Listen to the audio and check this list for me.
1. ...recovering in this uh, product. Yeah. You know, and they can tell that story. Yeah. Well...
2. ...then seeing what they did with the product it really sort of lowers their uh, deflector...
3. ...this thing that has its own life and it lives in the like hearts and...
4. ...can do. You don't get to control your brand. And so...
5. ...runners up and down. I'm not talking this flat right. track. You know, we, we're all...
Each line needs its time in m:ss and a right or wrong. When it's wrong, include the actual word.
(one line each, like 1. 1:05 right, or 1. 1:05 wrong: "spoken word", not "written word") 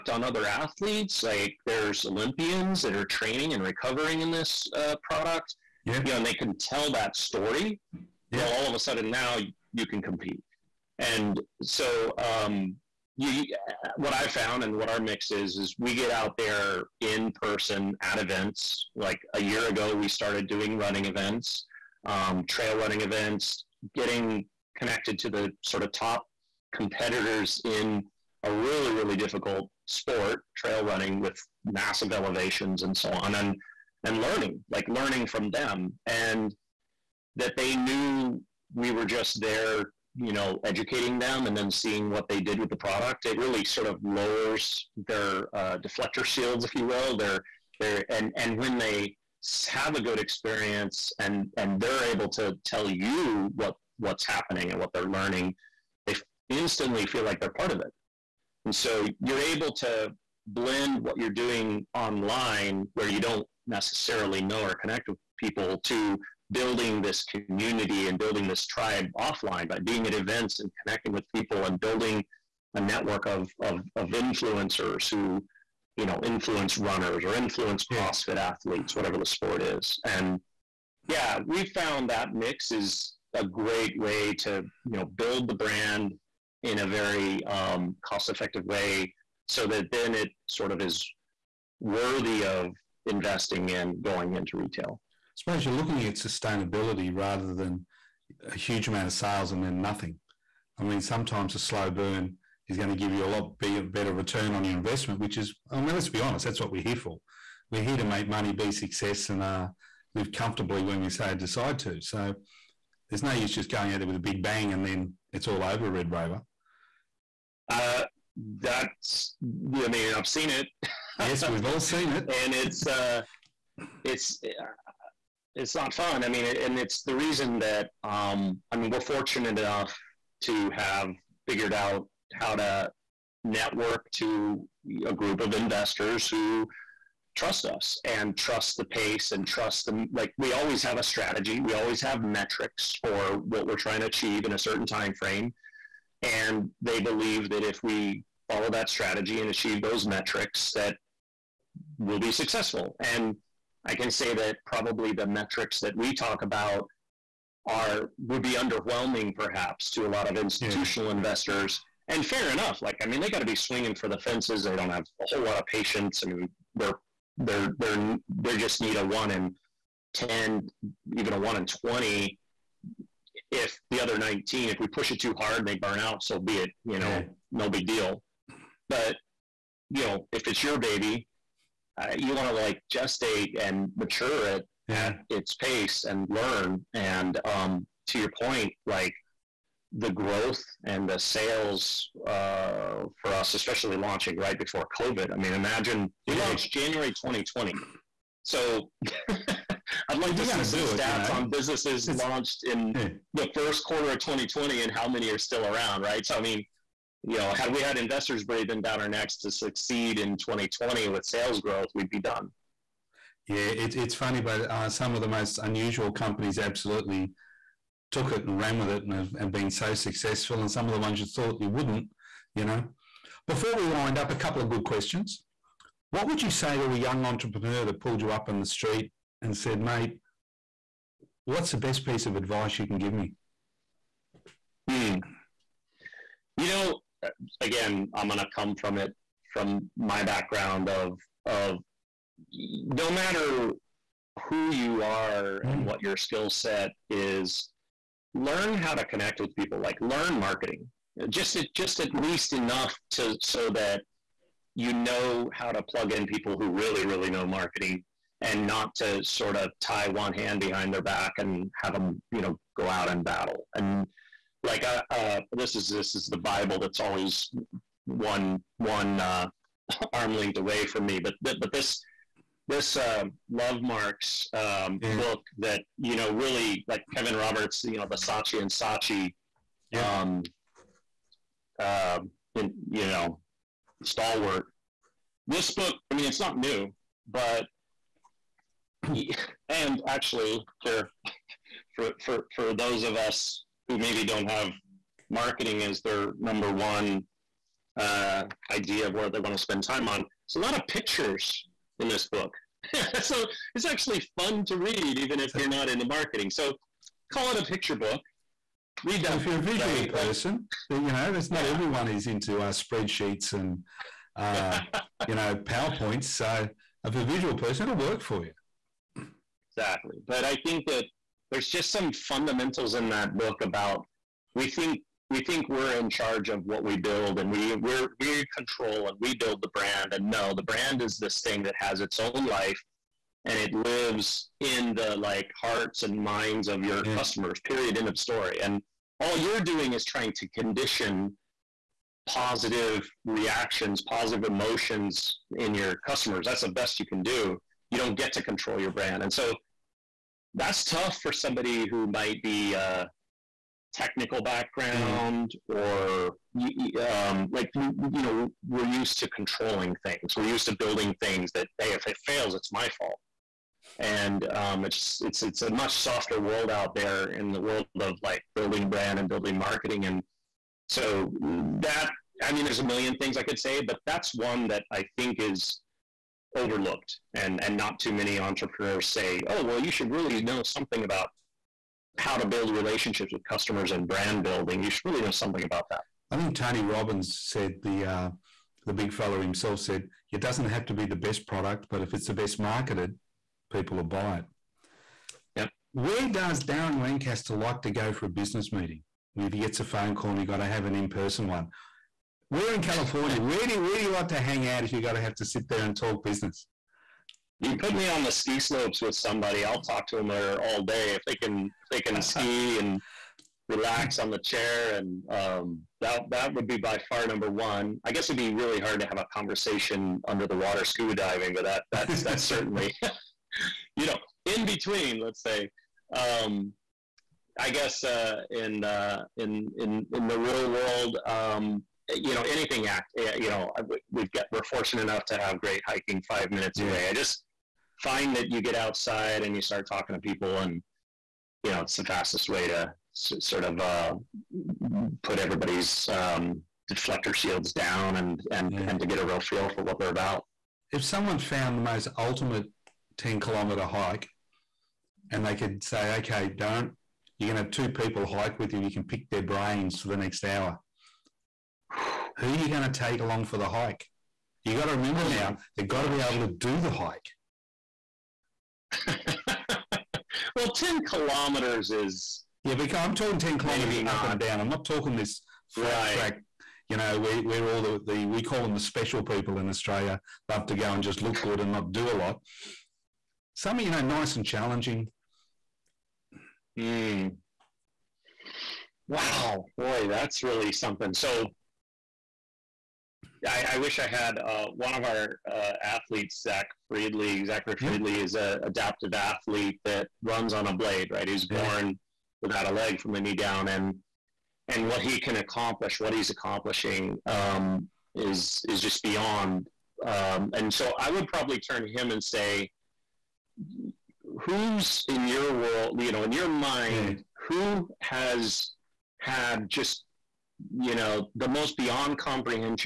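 1. 0:03 right
2. 0:41 right
3. 5:31 right
4. 5:47 right
5. 7:53 wrong: "kilometers", not "runners".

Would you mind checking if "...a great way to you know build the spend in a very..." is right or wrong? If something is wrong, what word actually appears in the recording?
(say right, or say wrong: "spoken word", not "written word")
wrong: "brand", not "spend".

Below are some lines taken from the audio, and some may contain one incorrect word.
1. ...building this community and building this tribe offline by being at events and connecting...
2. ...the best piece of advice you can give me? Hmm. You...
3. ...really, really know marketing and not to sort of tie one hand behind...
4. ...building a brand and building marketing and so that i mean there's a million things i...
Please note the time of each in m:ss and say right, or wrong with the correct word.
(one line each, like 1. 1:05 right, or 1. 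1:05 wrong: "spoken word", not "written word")
1. 1:06 right
2. 3:51 right
3. 4:16 right
4. 6:08 right.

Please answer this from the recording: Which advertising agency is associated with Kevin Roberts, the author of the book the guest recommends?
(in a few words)
Saatchi and Saatchi.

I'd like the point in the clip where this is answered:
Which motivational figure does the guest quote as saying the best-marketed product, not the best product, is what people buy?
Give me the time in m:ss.
6:26.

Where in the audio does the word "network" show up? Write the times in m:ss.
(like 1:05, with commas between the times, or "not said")
1:12, 2:13.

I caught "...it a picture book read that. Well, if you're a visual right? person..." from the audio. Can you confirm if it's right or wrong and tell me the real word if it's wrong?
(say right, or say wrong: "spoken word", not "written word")
right.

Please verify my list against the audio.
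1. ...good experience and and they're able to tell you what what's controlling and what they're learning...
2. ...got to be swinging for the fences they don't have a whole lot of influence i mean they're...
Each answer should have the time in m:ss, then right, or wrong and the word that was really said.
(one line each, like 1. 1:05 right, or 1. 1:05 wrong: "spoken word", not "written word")
1. 0:50 wrong: "happening", not "controlling"
2. 2:43 wrong: "patience", not "influence".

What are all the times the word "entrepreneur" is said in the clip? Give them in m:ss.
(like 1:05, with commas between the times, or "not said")
3:47, 6:18.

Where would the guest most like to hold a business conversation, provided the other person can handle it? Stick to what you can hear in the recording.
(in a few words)
On the ski slopes.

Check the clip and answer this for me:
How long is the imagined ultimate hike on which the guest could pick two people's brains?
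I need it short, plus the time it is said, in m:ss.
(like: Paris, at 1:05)
10 kilometers, at 7:33.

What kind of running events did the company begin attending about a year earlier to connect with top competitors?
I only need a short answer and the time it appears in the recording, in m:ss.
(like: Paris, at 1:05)
Trail running events, at 0:22.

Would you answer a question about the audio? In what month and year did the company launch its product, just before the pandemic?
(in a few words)
January 2020.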